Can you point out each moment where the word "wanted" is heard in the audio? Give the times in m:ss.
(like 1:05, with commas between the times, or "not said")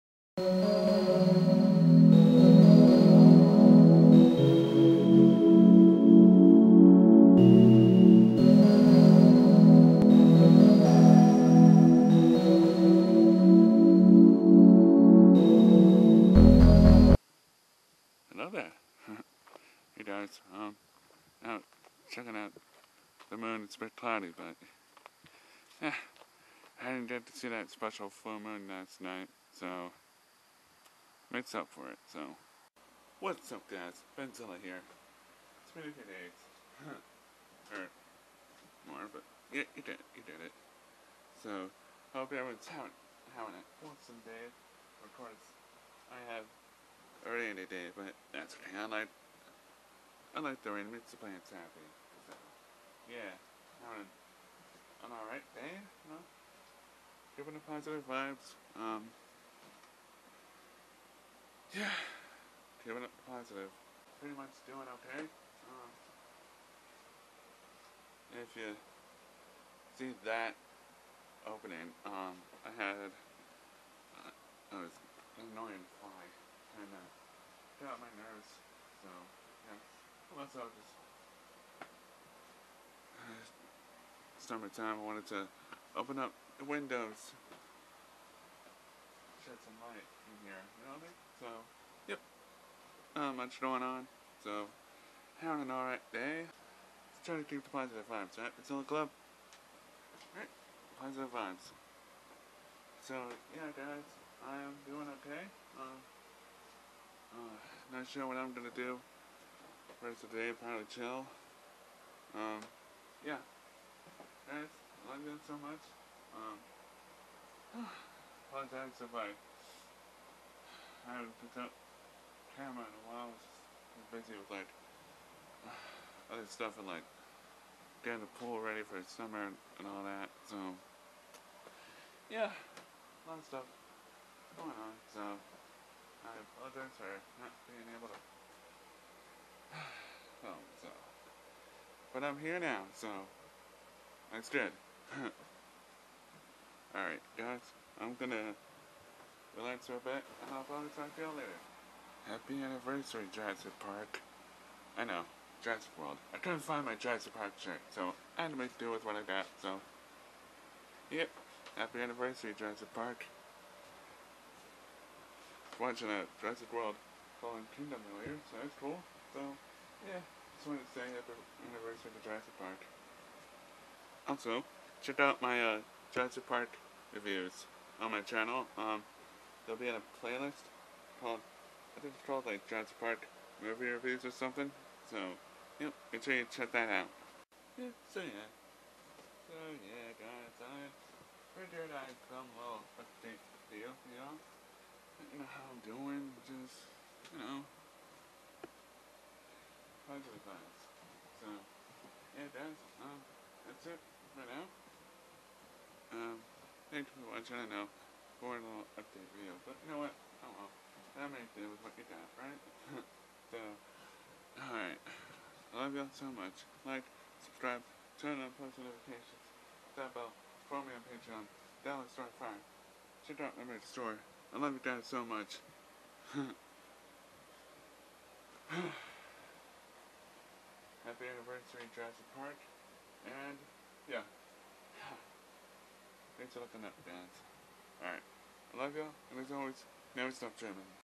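1:25, 2:50.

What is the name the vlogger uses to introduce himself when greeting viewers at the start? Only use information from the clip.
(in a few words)
Benzilla.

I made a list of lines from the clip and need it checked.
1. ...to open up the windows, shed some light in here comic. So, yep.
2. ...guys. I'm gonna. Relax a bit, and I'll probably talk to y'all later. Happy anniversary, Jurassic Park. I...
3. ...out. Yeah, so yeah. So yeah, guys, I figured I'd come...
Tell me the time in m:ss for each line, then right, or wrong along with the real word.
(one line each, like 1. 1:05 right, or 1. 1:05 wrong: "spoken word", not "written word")
1. 1:25 right
2. 2:27 right
3. 3:06 right.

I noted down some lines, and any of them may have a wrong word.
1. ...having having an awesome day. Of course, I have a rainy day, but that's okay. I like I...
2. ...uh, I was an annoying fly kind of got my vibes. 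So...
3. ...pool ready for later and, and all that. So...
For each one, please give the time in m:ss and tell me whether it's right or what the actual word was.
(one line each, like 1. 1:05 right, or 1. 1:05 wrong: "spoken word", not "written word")
1. 0:42 right
2. 1:14 wrong: "nerves", not "vibes"
3. 2:08 wrong: "summer", not "later".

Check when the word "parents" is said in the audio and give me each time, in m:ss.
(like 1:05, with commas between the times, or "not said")
not said.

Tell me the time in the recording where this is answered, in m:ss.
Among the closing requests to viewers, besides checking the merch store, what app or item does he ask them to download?
3:42.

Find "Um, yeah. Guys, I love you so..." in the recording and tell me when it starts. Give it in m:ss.
1:52.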